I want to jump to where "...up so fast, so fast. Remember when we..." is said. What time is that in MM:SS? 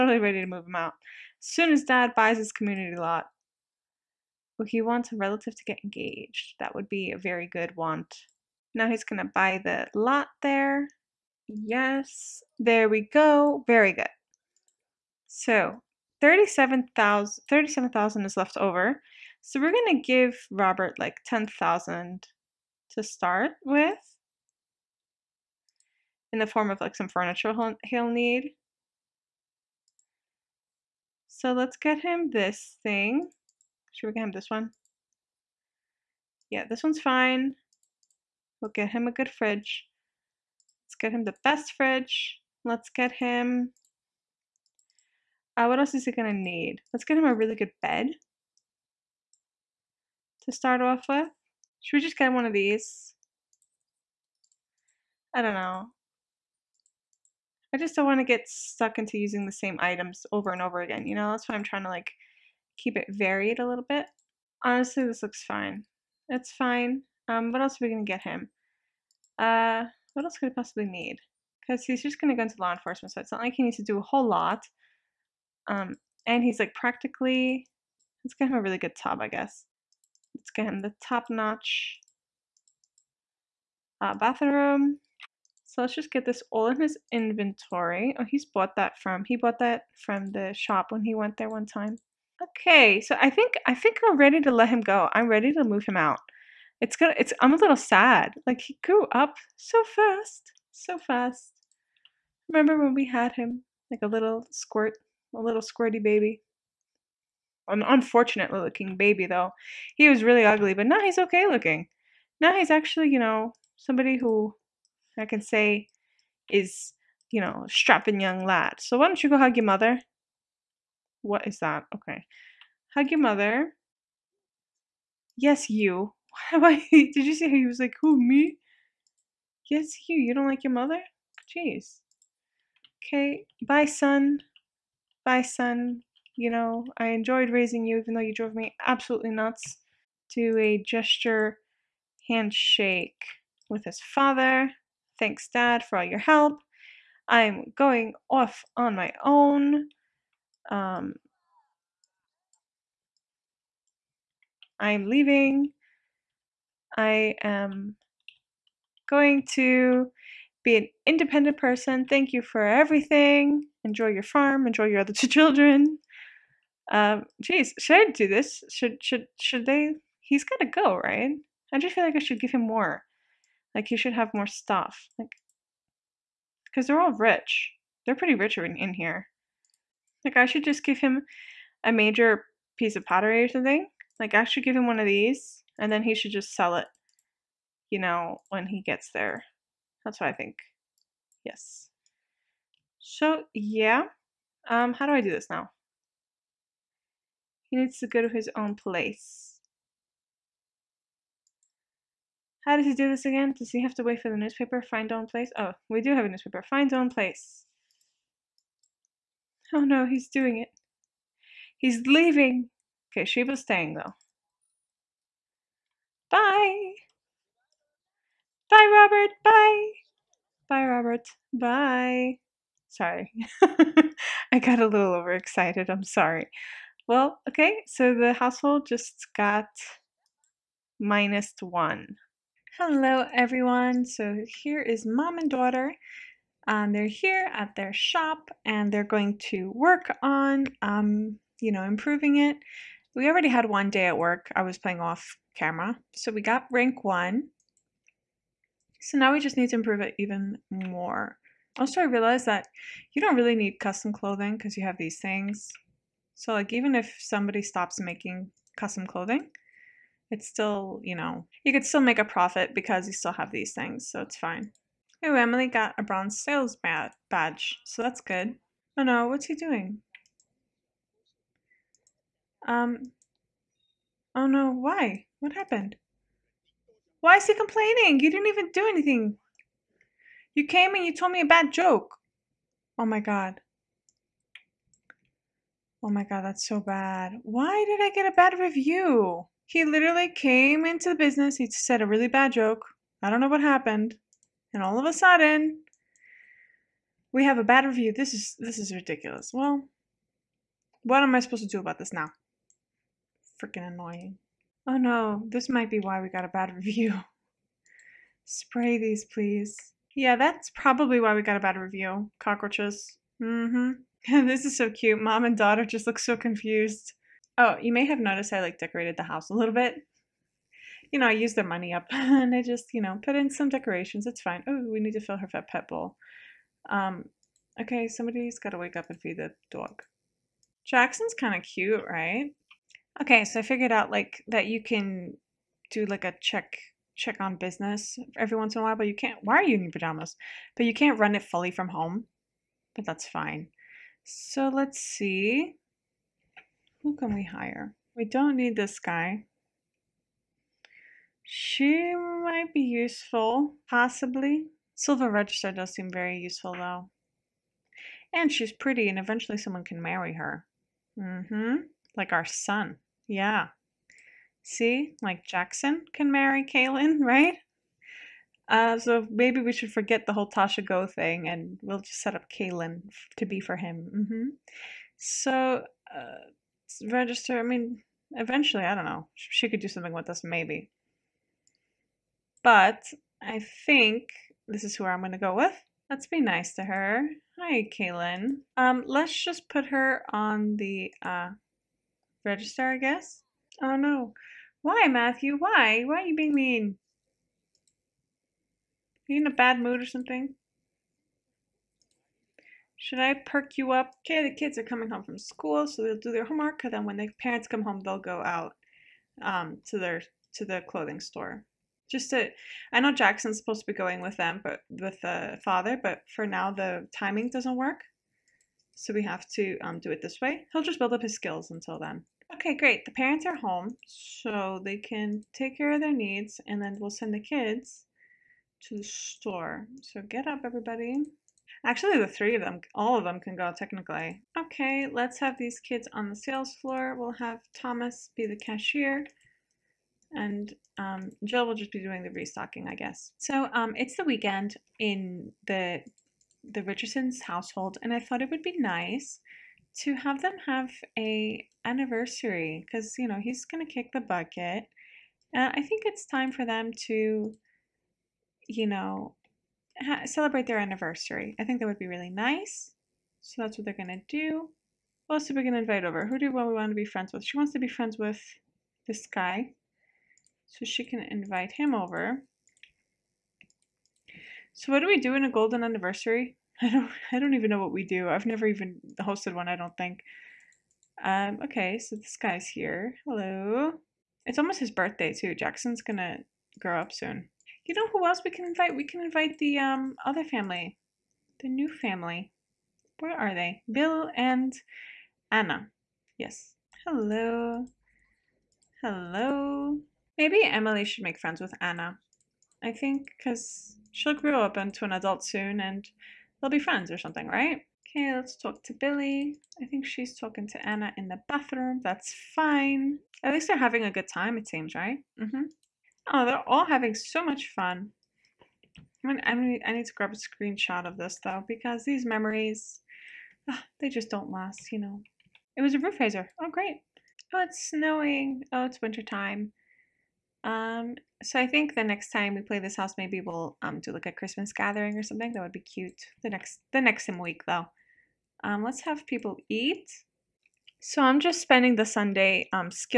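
01:39.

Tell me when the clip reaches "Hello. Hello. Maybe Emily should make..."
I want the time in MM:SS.
08:17.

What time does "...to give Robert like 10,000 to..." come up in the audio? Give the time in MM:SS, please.
00:19.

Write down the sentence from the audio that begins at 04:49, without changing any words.
He literally came into the business.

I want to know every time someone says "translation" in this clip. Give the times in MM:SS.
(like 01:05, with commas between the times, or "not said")
not said.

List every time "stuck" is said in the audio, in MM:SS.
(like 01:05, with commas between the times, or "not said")
00:58.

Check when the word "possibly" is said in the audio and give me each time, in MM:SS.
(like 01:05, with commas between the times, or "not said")
01:10, 05:53.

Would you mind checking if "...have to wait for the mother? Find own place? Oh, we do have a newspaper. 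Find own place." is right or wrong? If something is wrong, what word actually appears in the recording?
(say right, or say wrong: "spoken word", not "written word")
wrong: "newspaper", not "mother".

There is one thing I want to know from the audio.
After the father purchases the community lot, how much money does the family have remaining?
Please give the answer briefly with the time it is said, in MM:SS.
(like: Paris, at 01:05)
37,000, at 00:16.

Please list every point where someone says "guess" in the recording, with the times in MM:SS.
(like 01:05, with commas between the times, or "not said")
01:19, 06:32, 07:22.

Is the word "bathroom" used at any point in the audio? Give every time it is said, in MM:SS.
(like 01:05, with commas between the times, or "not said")
01:24, 08:31.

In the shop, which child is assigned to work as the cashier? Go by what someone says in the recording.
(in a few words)
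Thomas.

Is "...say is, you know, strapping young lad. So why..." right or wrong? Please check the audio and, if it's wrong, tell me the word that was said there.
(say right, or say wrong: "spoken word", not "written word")
right.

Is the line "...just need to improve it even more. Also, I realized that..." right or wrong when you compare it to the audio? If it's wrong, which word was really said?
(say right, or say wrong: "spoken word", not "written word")
right.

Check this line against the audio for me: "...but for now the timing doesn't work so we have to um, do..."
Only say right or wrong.
right.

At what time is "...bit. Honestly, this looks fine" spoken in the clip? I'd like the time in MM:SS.
01:03.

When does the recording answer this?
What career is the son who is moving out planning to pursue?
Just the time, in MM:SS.
01:12.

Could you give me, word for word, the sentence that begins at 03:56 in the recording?
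Um, they're here at their shop and they're going to work on, um, you know, improving it.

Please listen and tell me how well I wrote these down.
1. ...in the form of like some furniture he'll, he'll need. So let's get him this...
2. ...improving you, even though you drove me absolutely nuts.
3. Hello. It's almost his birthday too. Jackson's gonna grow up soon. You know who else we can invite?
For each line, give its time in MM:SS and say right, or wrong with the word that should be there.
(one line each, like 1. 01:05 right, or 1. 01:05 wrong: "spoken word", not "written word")
1. 00:26 right
2. 02:17 wrong: "raising", not "improving"
3. 08:03 right.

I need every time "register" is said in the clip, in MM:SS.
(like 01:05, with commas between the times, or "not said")
05:55, 06:17, 06:32.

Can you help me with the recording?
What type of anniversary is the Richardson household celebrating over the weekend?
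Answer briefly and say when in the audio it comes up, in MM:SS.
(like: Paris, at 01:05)
golden anniversary, at 07:55.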